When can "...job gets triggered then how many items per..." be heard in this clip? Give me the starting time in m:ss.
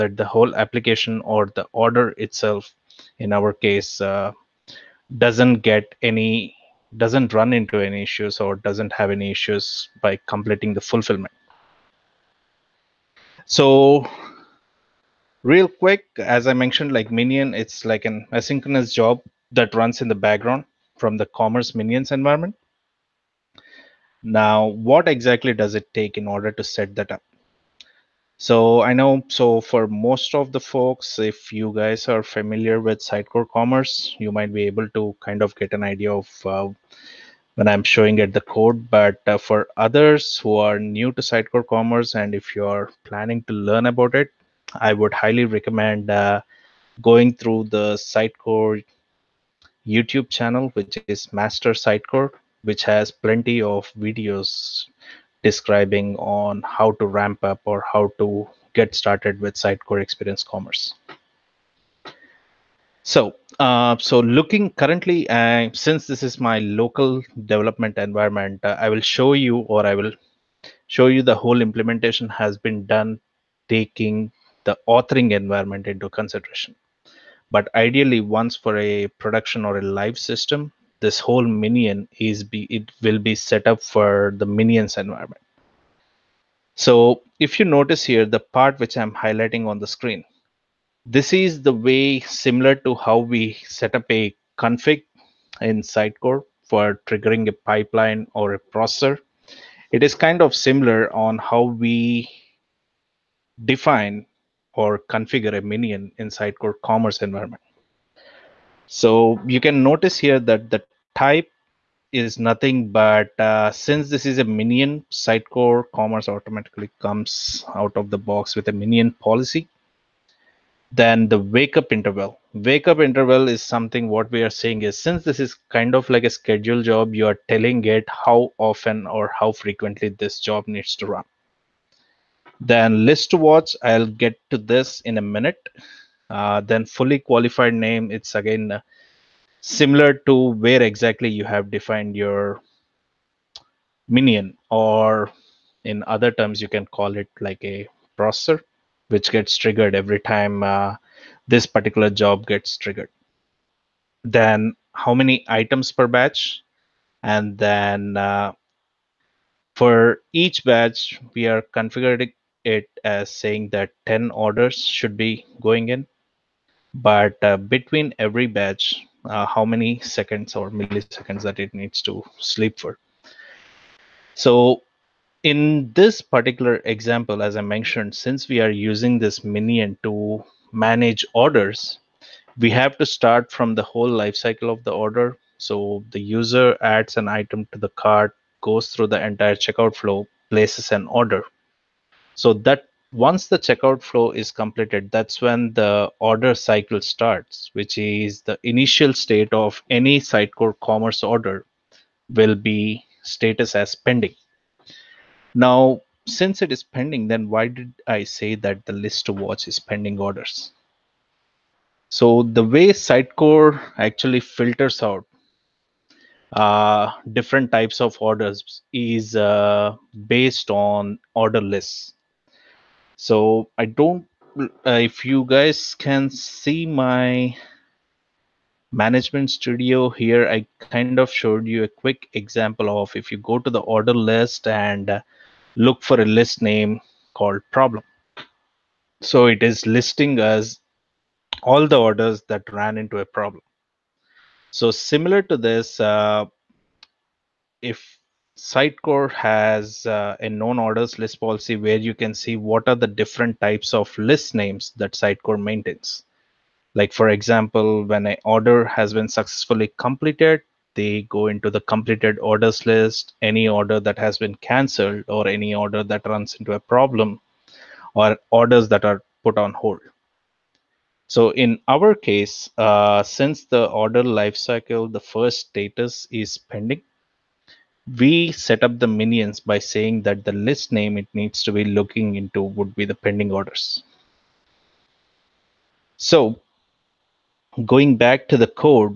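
2:32.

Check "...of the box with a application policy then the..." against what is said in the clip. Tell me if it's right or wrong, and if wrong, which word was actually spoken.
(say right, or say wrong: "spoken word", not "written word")
wrong: "minion", not "application".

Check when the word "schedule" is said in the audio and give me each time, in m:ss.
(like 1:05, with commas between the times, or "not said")
2:06.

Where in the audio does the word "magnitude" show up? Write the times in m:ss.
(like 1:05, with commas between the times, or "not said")
not said.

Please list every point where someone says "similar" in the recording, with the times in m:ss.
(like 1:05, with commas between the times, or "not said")
1:32, 1:40, 2:19, 4:04.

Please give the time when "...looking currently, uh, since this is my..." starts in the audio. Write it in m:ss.
1:04.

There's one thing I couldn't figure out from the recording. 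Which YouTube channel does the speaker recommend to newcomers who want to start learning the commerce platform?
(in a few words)
Master Sitecore.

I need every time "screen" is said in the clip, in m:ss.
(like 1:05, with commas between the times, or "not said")
1:29.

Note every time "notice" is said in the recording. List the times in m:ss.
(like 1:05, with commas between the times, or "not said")
1:27, 1:49.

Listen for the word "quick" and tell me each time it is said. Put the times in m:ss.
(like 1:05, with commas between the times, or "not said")
0:15, 3:51.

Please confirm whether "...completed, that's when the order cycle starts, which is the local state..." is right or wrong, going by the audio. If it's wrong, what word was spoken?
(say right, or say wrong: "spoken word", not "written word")
wrong: "initial", not "local".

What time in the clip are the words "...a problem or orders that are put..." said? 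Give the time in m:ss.
4:26.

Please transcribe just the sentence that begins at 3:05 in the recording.
So the user adds an item to the cart, goes through the entire checkout flow, places an order.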